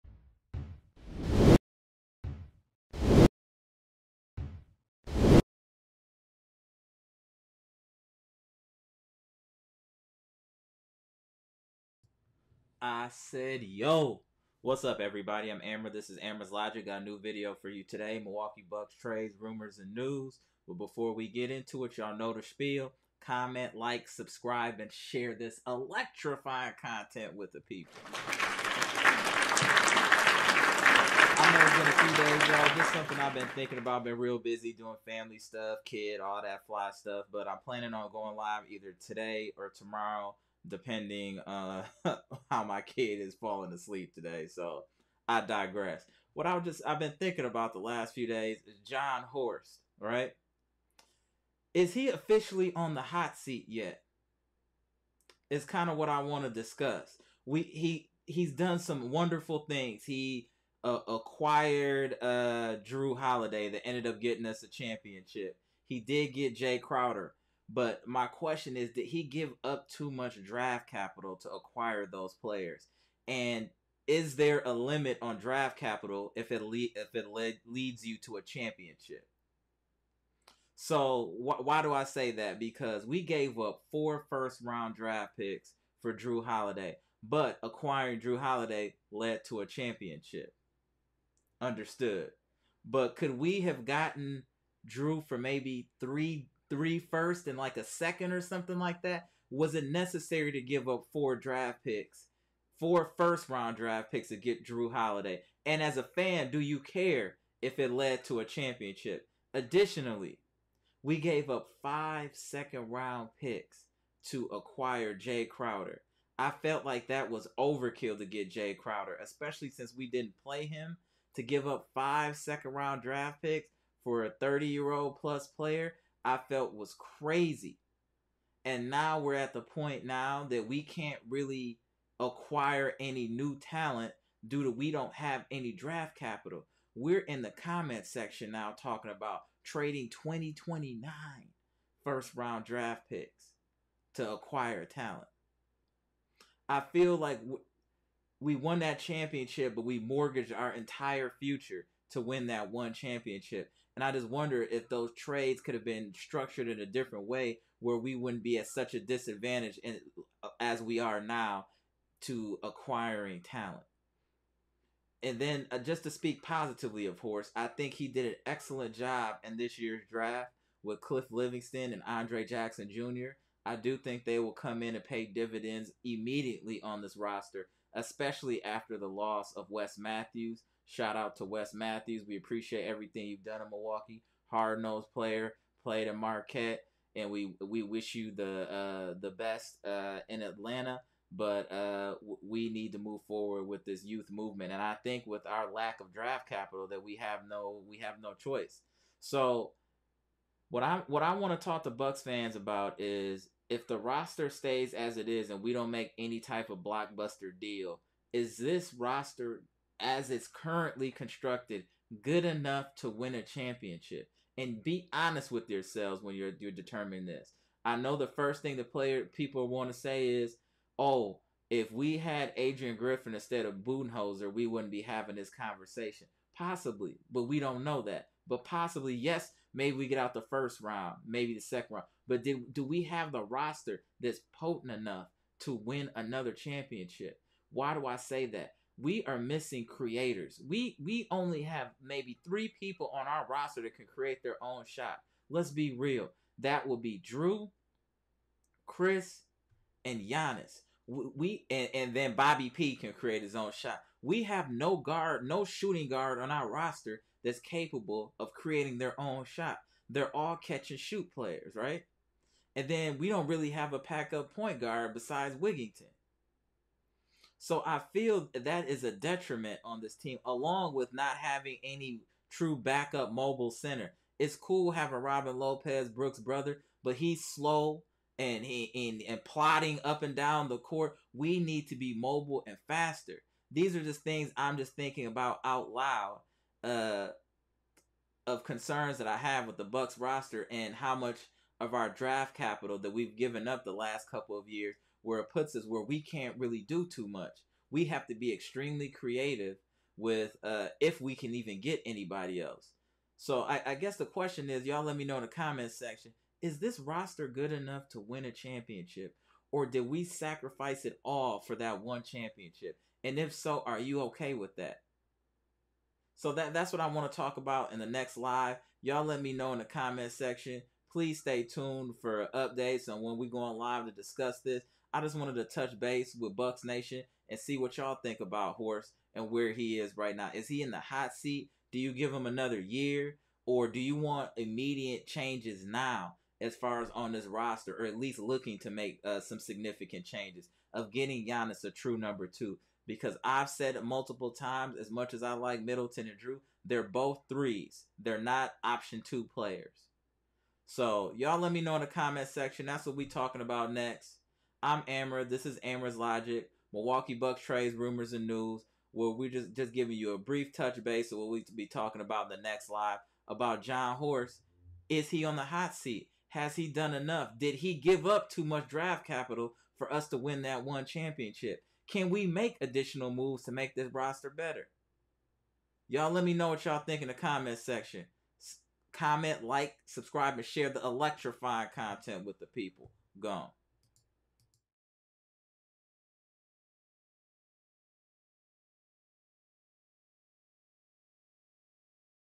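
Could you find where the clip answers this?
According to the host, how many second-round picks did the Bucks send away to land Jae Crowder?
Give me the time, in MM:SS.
01:51.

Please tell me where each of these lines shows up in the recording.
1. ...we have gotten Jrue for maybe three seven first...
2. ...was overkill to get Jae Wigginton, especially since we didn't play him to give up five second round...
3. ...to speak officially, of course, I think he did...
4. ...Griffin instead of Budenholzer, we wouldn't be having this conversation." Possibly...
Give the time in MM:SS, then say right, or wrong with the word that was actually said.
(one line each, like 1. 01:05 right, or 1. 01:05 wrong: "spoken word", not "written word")
1. 01:33 wrong: "three", not "seven"
2. 01:57 wrong: "Crowder", not "Wigginton"
3. 02:46 wrong: "positively", not "officially"
4. 03:42 right.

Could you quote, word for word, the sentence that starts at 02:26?
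I feel like we won that championship, but we mortgaged our entire future to win that one championship.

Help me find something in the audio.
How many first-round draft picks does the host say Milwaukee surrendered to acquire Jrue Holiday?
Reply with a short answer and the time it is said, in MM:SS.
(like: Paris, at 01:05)
4, at 01:23.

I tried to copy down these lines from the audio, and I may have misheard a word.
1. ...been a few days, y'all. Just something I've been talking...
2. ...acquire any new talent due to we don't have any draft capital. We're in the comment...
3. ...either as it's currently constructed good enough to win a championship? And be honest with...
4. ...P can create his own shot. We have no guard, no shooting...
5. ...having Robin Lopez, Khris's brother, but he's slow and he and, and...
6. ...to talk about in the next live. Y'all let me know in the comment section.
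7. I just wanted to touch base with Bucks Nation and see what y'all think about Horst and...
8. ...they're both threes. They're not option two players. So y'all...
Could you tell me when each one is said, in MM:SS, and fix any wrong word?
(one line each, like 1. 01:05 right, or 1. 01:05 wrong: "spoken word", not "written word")
1. 00:31 wrong: "thinking", not "talking"
2. 02:12 right
3. 03:28 wrong: "roster", not "either"
4. 04:12 right
5. 04:34 wrong: "Brook", not "Khris"
6. 05:17 right
7. 05:25 right
8. 05:46 right.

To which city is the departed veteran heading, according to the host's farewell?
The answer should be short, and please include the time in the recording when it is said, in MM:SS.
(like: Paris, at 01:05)
Atlanta, at 03:10.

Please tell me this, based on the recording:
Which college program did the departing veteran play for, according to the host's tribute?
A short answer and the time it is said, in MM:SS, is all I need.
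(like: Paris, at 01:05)
Marquette, at 03:06.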